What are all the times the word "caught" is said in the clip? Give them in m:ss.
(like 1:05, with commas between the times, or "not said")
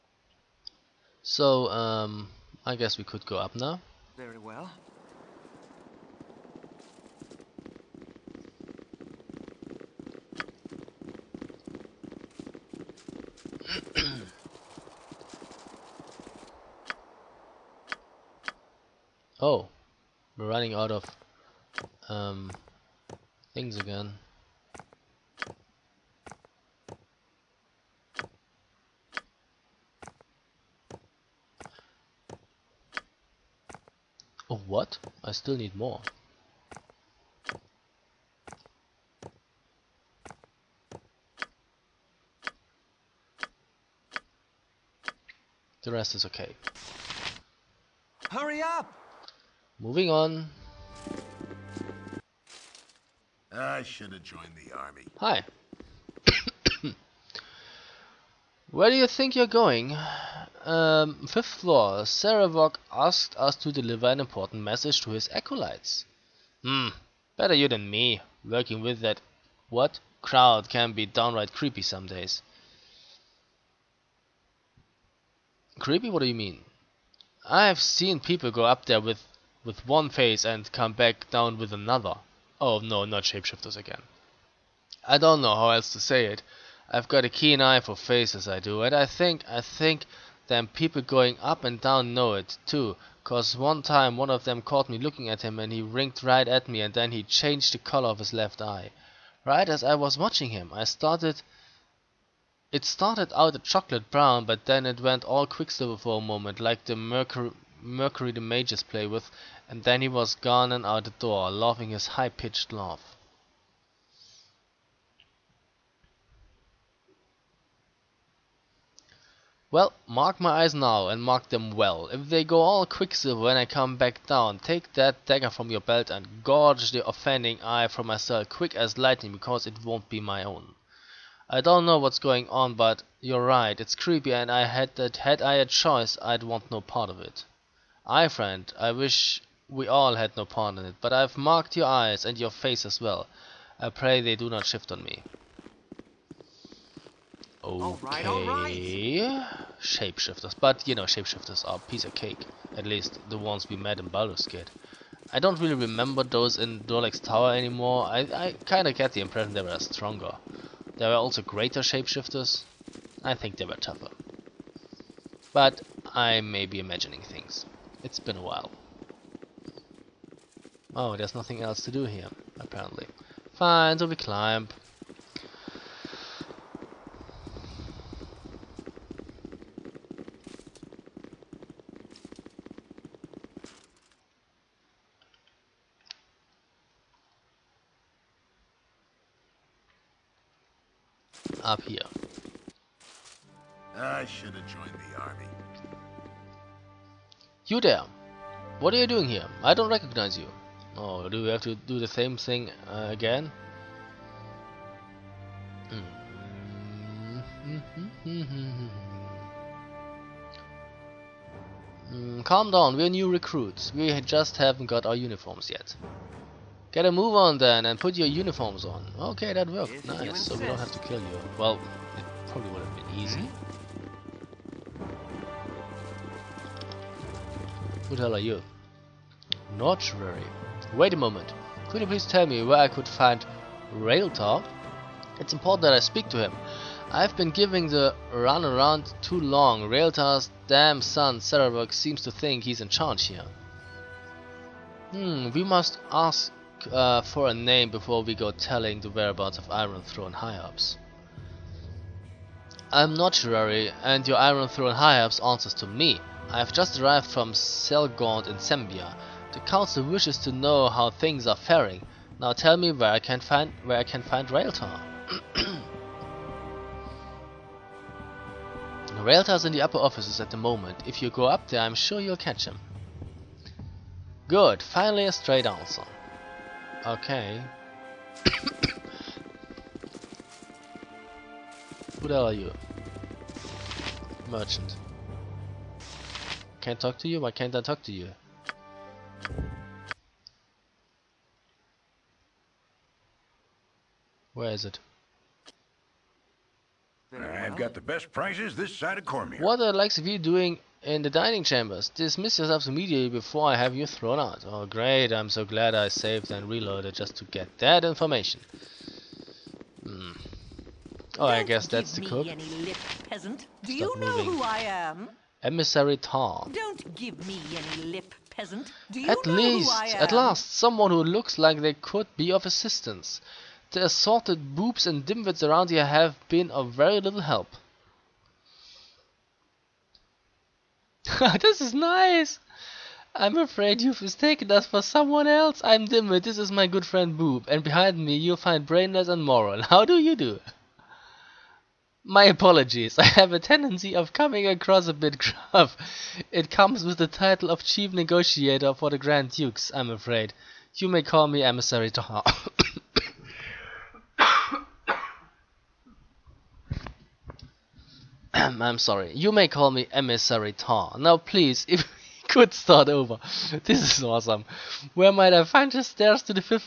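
1:34.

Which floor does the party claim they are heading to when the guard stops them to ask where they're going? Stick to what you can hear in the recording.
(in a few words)
Fifth floor.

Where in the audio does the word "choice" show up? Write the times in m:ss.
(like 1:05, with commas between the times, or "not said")
2:15.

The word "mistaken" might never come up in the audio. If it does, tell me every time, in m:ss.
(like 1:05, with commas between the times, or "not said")
5:34.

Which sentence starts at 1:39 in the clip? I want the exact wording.
Right as I was watching him, I started...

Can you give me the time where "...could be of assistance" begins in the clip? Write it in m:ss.
5:21.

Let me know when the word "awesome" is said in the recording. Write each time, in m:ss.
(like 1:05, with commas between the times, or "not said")
6:04.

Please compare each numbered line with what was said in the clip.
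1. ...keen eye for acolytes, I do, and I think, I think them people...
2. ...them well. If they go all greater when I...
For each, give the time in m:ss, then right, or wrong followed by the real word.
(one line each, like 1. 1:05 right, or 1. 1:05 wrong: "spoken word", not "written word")
1. 1:27 wrong: "faces", not "acolytes"
2. 2:01 wrong: "quicksilver", not "greater".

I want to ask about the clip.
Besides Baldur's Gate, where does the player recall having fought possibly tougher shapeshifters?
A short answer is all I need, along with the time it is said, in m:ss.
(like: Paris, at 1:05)
Durlag's Tower, at 2:36.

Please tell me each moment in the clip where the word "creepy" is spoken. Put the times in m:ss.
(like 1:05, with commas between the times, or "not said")
1:11, 1:15, 2:13.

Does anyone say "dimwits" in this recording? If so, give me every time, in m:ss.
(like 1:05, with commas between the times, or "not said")
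5:25, 5:36.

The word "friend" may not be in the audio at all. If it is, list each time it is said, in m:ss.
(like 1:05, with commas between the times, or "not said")
2:18, 5:37.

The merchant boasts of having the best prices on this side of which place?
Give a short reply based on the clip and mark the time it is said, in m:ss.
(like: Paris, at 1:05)
Cormyr, at 4:59.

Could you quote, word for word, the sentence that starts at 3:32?
Mm, calm down, we're new recruits.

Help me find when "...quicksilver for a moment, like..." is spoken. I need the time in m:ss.
1:45.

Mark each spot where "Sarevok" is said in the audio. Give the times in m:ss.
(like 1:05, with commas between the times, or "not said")
1:02, 4:01.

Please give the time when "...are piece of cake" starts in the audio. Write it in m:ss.
2:31.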